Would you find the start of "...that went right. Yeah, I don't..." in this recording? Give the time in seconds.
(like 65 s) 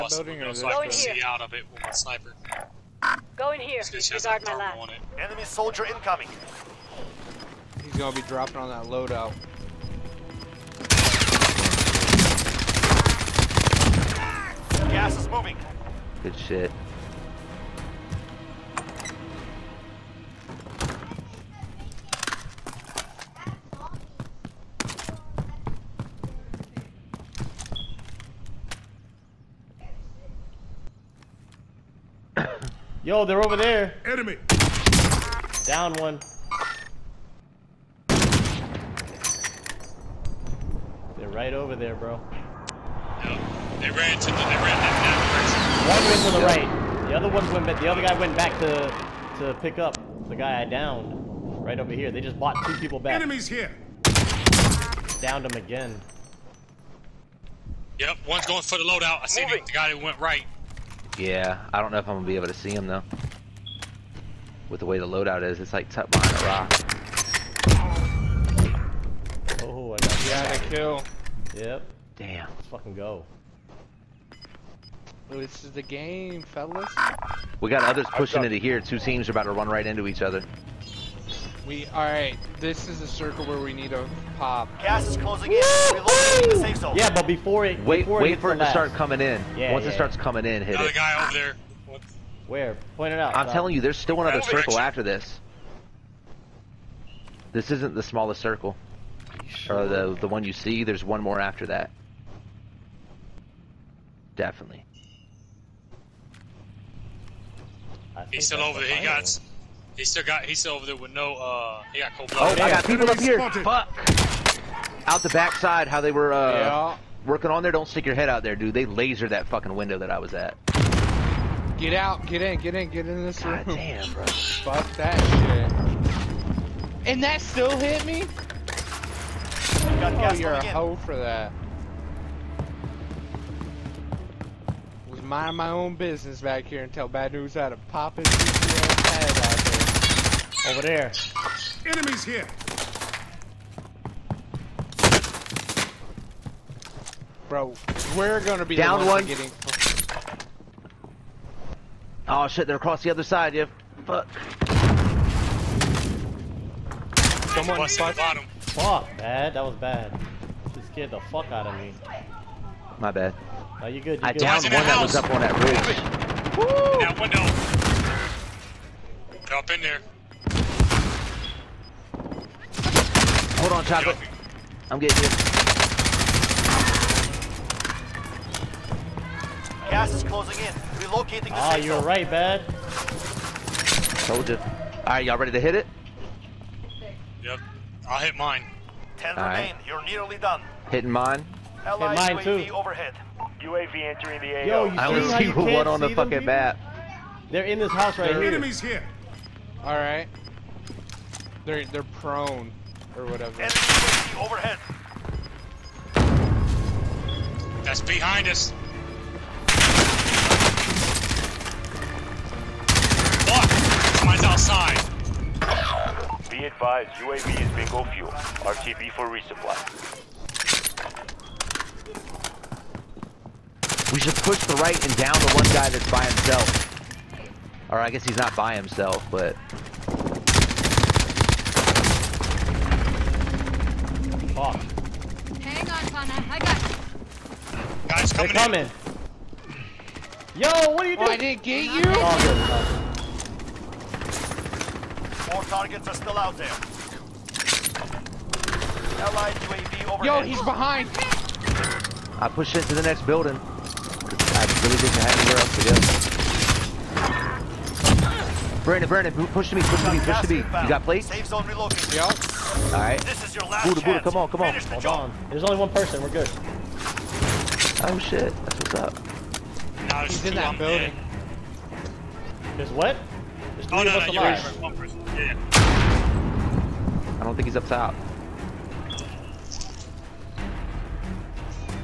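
59 s.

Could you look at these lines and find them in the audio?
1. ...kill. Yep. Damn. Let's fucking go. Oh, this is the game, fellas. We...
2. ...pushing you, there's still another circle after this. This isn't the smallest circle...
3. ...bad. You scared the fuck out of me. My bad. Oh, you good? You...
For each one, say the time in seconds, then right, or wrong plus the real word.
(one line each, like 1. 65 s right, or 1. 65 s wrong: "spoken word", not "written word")
1. 70 s right
2. 93 s wrong: "telling", not "pushing"
3. 159 s right.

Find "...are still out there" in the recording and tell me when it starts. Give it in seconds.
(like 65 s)
246 s.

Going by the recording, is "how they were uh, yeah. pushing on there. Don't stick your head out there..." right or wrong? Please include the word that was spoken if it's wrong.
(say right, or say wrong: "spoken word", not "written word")
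wrong: "working", not "pushing".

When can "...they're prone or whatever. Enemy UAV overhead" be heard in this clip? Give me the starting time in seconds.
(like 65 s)
201 s.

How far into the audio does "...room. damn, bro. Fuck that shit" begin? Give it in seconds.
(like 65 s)
123 s.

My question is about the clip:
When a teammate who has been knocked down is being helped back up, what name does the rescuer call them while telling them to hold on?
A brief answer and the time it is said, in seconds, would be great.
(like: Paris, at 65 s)
Chocolate, at 173 s.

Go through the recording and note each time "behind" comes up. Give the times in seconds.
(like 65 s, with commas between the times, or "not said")
66 s, 208 s, 250 s.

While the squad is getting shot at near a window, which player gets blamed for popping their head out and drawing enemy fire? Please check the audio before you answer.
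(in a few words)
Bad News.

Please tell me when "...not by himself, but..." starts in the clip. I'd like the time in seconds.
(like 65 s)
228 s.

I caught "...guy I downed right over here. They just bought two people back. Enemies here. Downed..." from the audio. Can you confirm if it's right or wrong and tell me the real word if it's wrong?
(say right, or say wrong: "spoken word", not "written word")
right.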